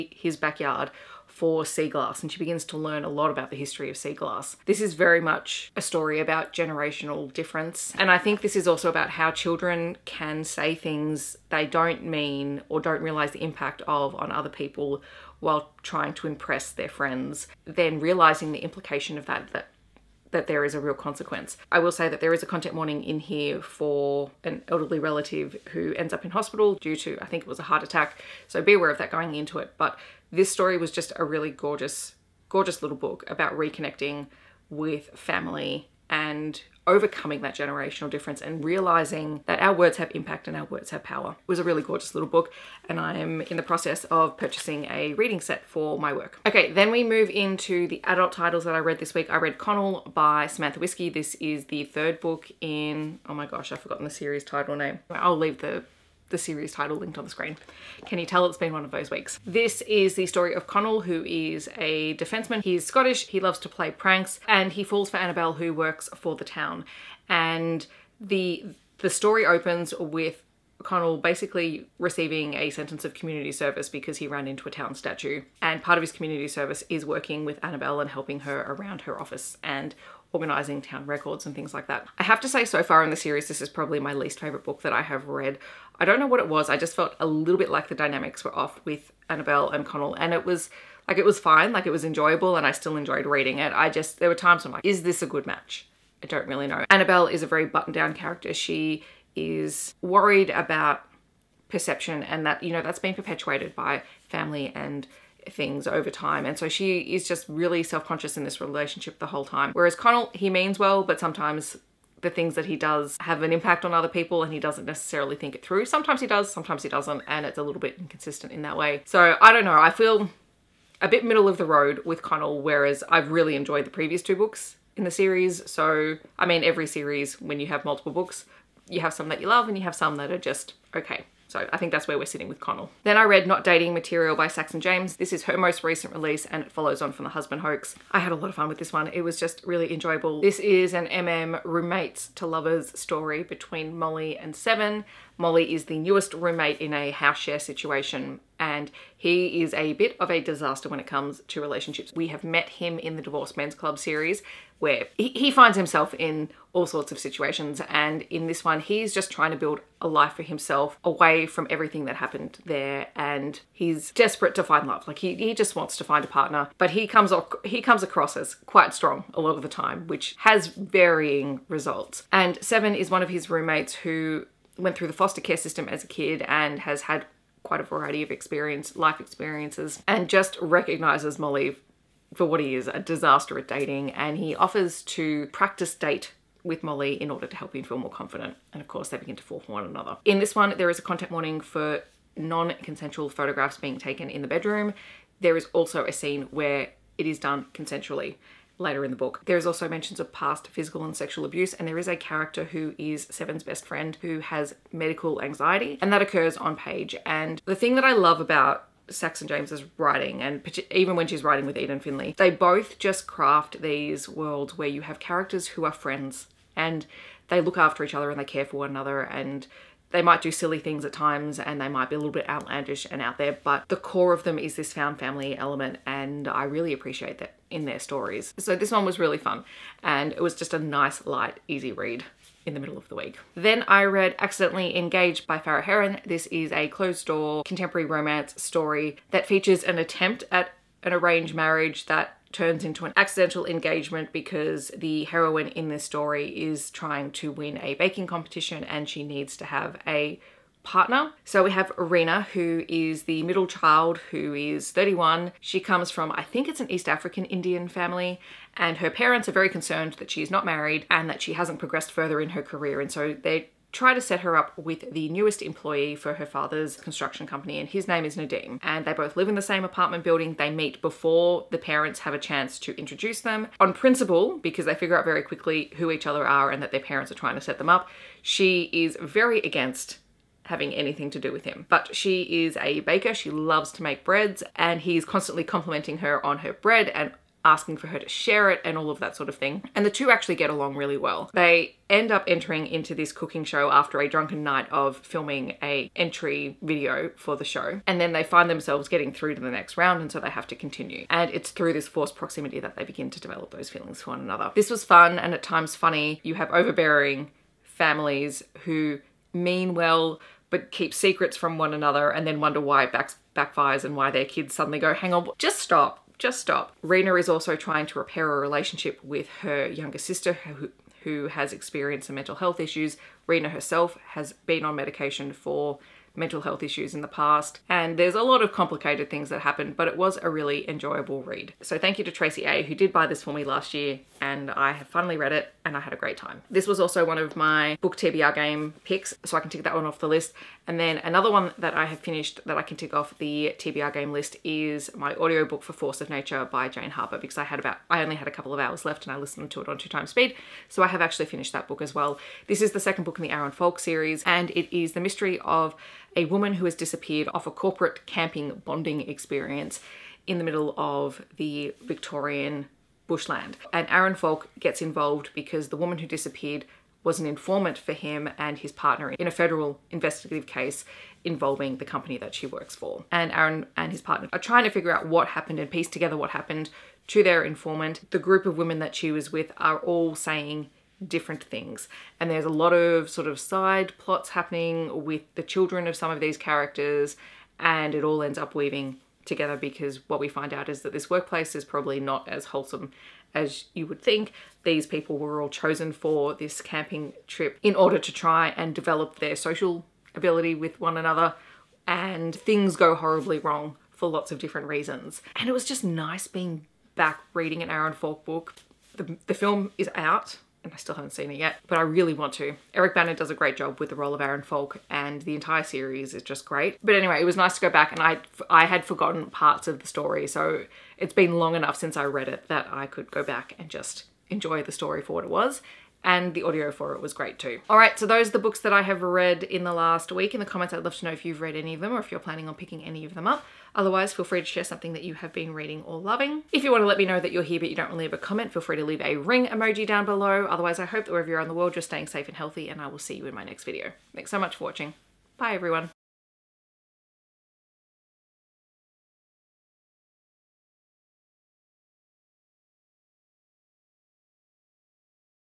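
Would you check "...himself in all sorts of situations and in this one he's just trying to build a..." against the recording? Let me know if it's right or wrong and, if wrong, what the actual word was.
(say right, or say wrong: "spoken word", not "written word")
right.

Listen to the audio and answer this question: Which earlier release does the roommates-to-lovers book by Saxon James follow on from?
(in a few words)
The Husband Hoax.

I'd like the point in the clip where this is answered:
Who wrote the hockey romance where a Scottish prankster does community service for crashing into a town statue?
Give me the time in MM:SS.
00:50.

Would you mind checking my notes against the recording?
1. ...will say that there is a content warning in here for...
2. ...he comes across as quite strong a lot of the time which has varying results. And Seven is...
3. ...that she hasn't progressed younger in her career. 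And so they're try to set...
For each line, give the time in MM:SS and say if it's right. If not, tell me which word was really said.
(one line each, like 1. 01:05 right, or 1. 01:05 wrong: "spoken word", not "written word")
1. 00:21 right
2. 02:47 right
3. 04:21 wrong: "further", not "younger".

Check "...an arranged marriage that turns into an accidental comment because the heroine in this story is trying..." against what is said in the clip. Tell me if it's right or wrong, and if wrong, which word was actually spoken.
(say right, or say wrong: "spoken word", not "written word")
wrong: "engagement", not "comment".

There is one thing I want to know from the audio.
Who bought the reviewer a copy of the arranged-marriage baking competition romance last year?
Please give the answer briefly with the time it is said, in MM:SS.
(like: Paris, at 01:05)
Tracy A, at 05:32.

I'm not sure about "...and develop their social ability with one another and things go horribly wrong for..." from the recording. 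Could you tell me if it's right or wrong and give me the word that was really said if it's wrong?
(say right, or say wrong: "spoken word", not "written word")
right.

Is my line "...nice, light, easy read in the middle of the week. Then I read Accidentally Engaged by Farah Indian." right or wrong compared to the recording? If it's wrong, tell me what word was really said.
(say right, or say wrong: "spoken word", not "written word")
wrong: "Heron", not "Indian".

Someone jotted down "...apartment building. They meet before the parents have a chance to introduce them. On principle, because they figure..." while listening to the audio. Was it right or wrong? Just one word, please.
right.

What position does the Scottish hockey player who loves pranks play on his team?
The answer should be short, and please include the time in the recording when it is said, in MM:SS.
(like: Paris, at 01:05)
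Defenseman, at 01:02.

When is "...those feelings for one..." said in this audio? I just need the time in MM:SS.
05:03.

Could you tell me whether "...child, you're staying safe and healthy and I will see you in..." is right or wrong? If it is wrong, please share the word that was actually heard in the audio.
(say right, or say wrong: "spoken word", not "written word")
wrong: "world", not "child".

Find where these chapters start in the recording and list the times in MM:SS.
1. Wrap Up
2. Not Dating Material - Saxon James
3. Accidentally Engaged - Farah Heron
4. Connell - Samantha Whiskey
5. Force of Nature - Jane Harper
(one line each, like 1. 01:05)
1. 07:07
2. 02:12
3. 03:53
4. 00:46
5. 05:40.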